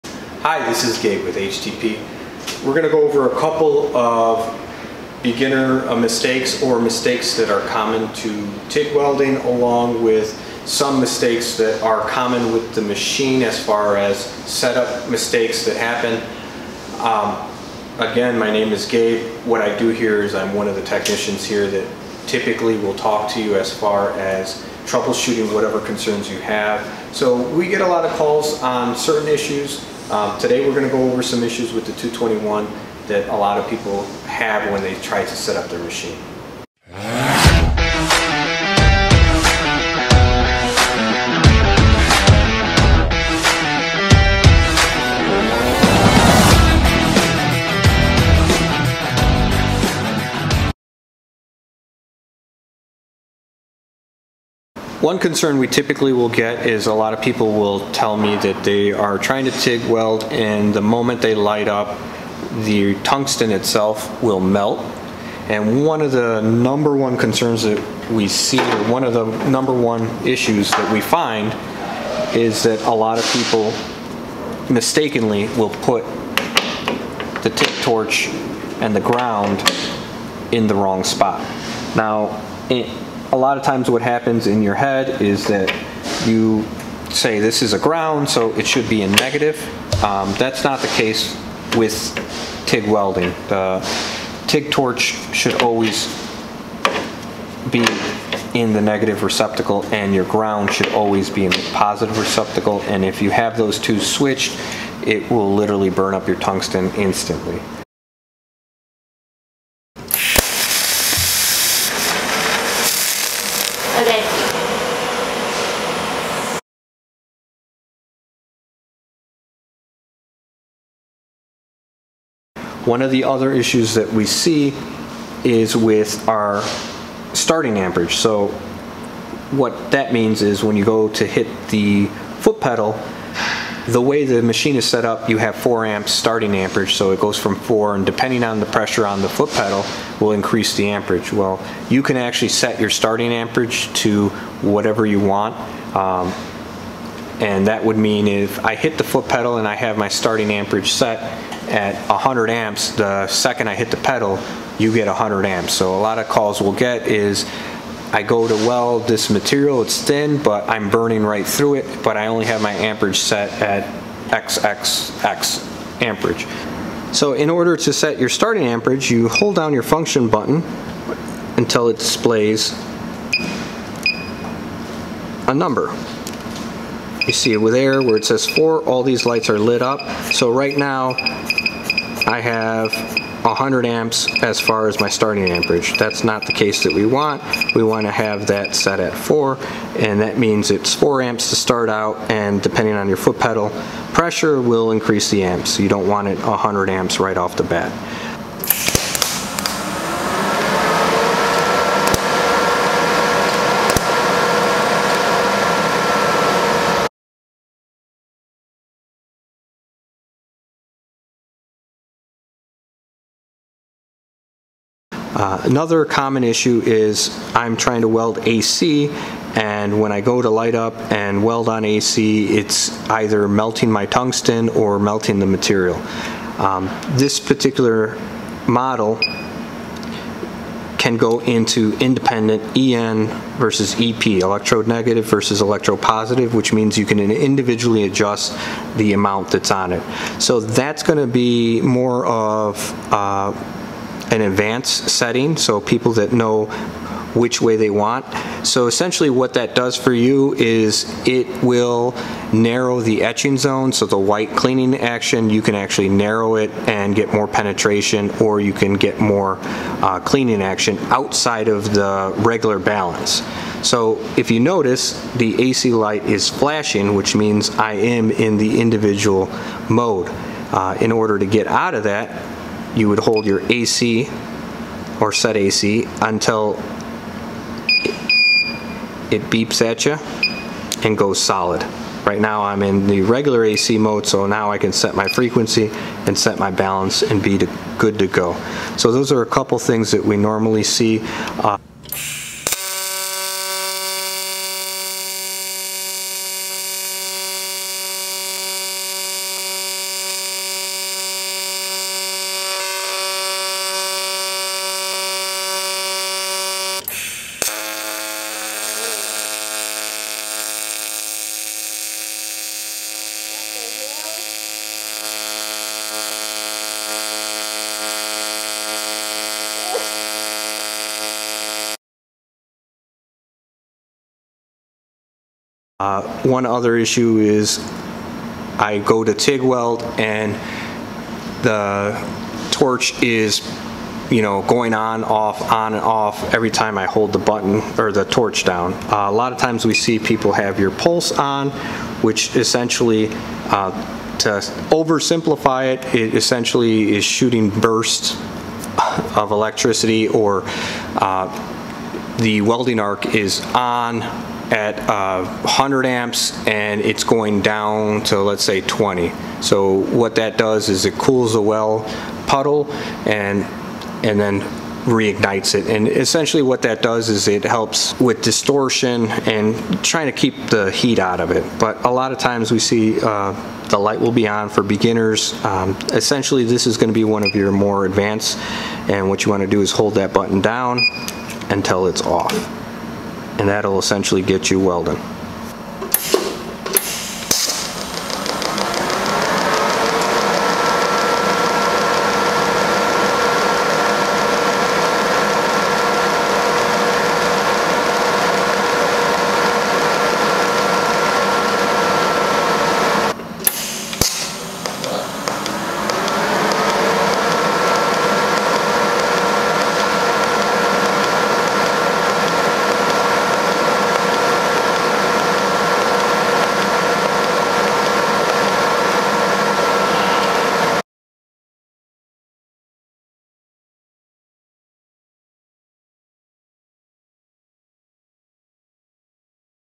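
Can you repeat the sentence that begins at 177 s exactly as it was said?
You see over there where it says 4, all these lights are lit up.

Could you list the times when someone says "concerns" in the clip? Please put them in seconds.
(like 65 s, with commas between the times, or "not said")
25 s, 55 s, 67 s.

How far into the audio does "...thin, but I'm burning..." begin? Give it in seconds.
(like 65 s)
160 s.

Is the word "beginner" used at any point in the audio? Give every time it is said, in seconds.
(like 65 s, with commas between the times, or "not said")
5 s, 374 s.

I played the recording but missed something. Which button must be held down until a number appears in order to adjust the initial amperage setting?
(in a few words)
function button.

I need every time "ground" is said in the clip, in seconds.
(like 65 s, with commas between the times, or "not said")
78 s, 87 s, 100 s.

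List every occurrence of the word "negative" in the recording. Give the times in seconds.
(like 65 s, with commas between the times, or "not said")
89 s, 98 s, 234 s.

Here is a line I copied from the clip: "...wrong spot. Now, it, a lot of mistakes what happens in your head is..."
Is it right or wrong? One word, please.
wrong.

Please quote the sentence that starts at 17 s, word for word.
Um, again, my name is Gabe.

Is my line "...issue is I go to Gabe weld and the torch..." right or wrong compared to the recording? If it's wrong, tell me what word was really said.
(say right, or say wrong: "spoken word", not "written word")
wrong: "TIG", not "Gabe".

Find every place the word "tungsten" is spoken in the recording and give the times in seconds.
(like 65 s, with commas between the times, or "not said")
63 s, 106 s, 224 s.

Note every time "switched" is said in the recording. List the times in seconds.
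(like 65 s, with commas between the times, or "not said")
104 s.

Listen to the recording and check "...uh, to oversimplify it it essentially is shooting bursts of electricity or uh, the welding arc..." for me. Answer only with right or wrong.
right.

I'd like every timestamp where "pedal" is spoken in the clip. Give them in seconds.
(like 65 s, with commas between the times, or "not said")
132 s, 139 s, 149 s, 153 s, 193 s.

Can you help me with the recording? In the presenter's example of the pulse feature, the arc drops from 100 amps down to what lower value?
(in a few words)
20.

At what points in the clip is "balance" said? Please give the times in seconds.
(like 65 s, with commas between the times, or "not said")
262 s, 286 s.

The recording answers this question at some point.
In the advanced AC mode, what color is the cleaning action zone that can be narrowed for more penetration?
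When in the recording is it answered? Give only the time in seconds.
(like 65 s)
254 s.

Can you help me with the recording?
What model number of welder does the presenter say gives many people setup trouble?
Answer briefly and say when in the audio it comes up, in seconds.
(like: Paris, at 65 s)
221, at 31 s.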